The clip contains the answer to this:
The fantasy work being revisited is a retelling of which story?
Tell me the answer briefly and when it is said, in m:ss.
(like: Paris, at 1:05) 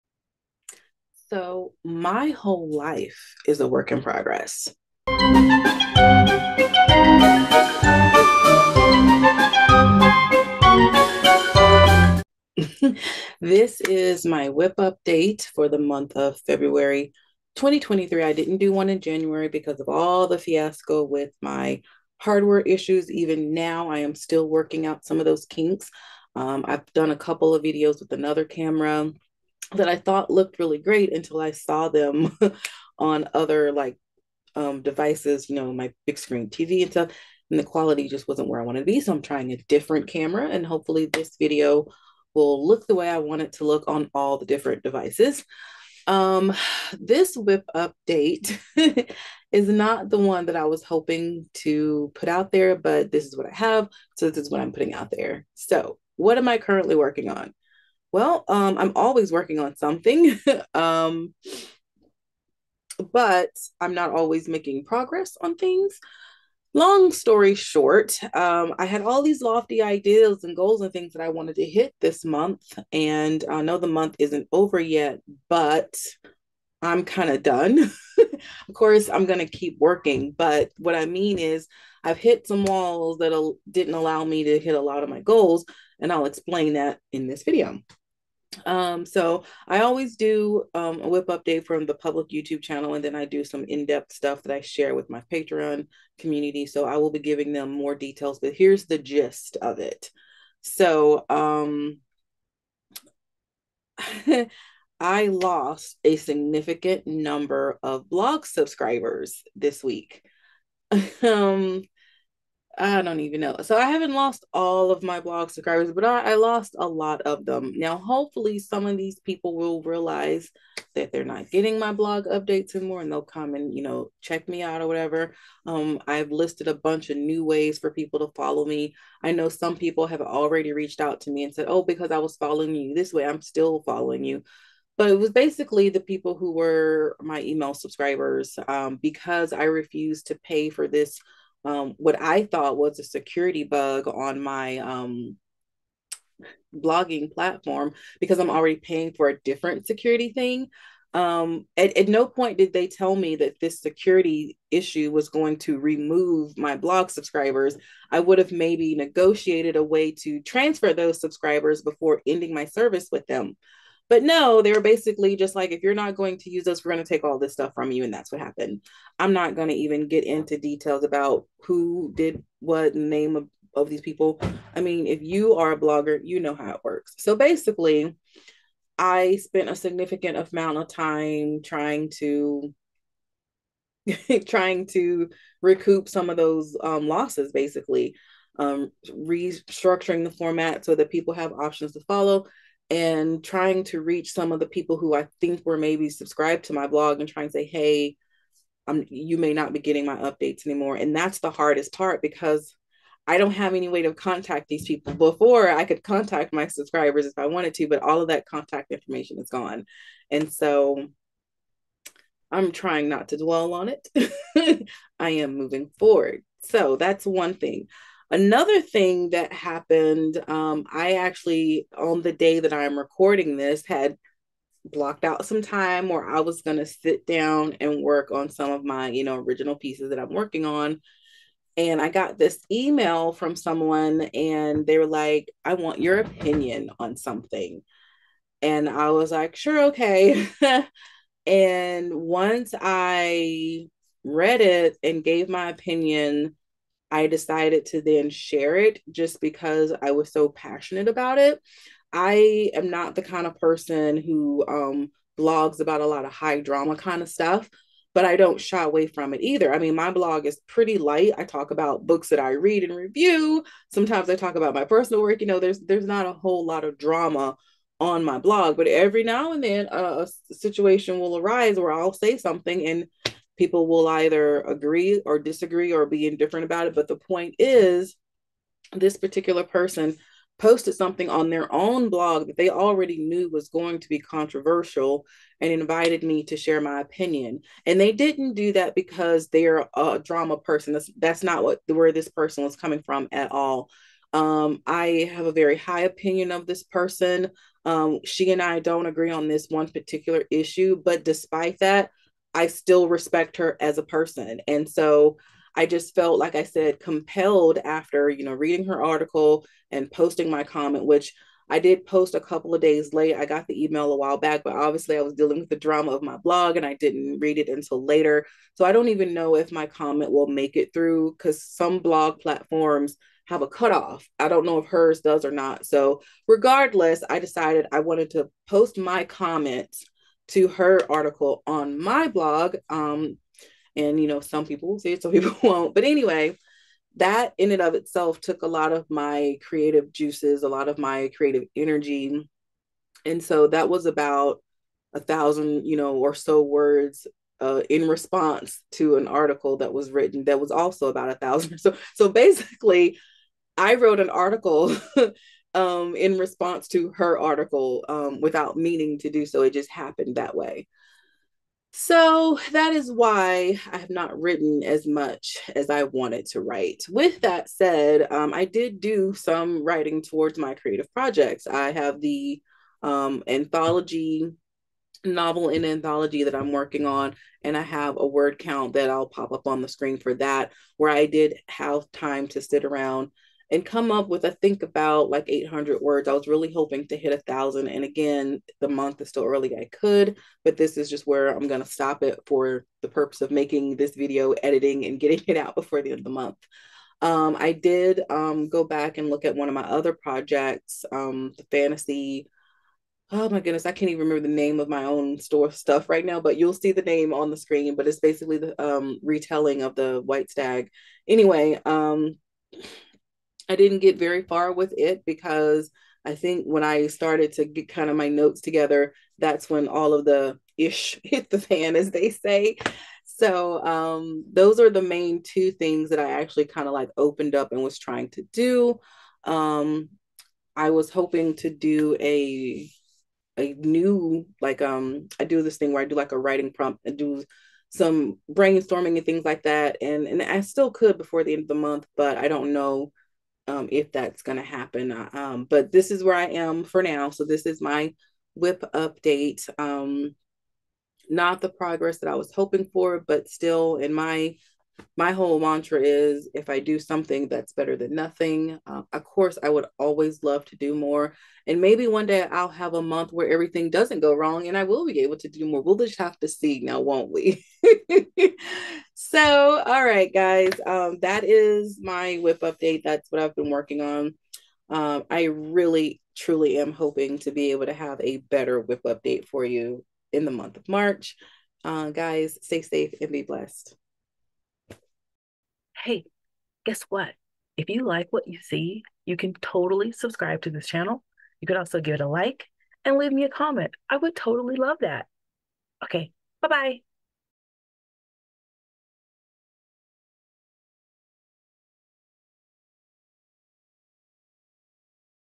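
the White Stag, at 6:49.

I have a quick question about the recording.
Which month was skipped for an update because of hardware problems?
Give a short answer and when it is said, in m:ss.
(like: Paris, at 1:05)
January, at 0:18.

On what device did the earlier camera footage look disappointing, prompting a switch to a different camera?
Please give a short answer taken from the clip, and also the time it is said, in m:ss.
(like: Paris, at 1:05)
big screen TV, at 0:36.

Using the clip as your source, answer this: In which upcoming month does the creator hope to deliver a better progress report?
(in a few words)
March.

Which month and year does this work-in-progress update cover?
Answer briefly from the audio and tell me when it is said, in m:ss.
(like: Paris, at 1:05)
February 2023, at 0:16.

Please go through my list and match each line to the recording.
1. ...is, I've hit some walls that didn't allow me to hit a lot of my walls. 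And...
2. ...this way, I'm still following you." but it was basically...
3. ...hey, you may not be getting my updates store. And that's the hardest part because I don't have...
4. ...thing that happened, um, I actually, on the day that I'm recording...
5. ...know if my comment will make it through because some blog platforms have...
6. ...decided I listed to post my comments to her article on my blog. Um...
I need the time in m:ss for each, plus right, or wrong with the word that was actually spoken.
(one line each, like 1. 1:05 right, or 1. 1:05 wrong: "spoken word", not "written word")
1. 1:21 wrong: "goals", not "walls"
2. 2:12 right
3. 3:17 wrong: "anymore", not "store"
4. 3:38 right
5. 5:19 right
6. 5:27 wrong: "wanted", not "listed".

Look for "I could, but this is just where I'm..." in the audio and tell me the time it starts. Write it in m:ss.
6:29.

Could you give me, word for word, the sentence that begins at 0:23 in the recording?
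Even now, I am still working out some of those kinks.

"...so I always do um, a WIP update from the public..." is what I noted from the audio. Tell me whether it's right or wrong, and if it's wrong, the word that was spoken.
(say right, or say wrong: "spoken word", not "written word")
right.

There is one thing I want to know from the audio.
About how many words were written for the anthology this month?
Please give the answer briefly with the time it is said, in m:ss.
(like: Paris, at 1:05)
800, at 6:25.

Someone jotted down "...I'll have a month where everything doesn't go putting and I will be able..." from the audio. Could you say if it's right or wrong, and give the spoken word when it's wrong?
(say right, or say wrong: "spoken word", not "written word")
wrong: "wrong", not "putting".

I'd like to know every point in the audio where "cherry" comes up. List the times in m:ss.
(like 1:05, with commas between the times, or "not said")
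not said.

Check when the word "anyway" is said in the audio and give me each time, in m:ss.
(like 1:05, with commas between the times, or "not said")
5:36, 6:51.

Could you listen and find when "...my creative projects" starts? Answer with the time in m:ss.
6:10.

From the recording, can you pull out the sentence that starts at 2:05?
Um, I've listed a bunch of new ways for people to follow me.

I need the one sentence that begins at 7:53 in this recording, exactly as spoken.
That's what I've been working on.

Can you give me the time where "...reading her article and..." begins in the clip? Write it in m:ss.
5:08.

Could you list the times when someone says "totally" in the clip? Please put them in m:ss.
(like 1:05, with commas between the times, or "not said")
8:09, 8:14.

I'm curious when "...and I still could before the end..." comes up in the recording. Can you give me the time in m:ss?
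7:20.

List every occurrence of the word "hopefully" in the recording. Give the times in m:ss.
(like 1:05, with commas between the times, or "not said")
0:40, 1:57.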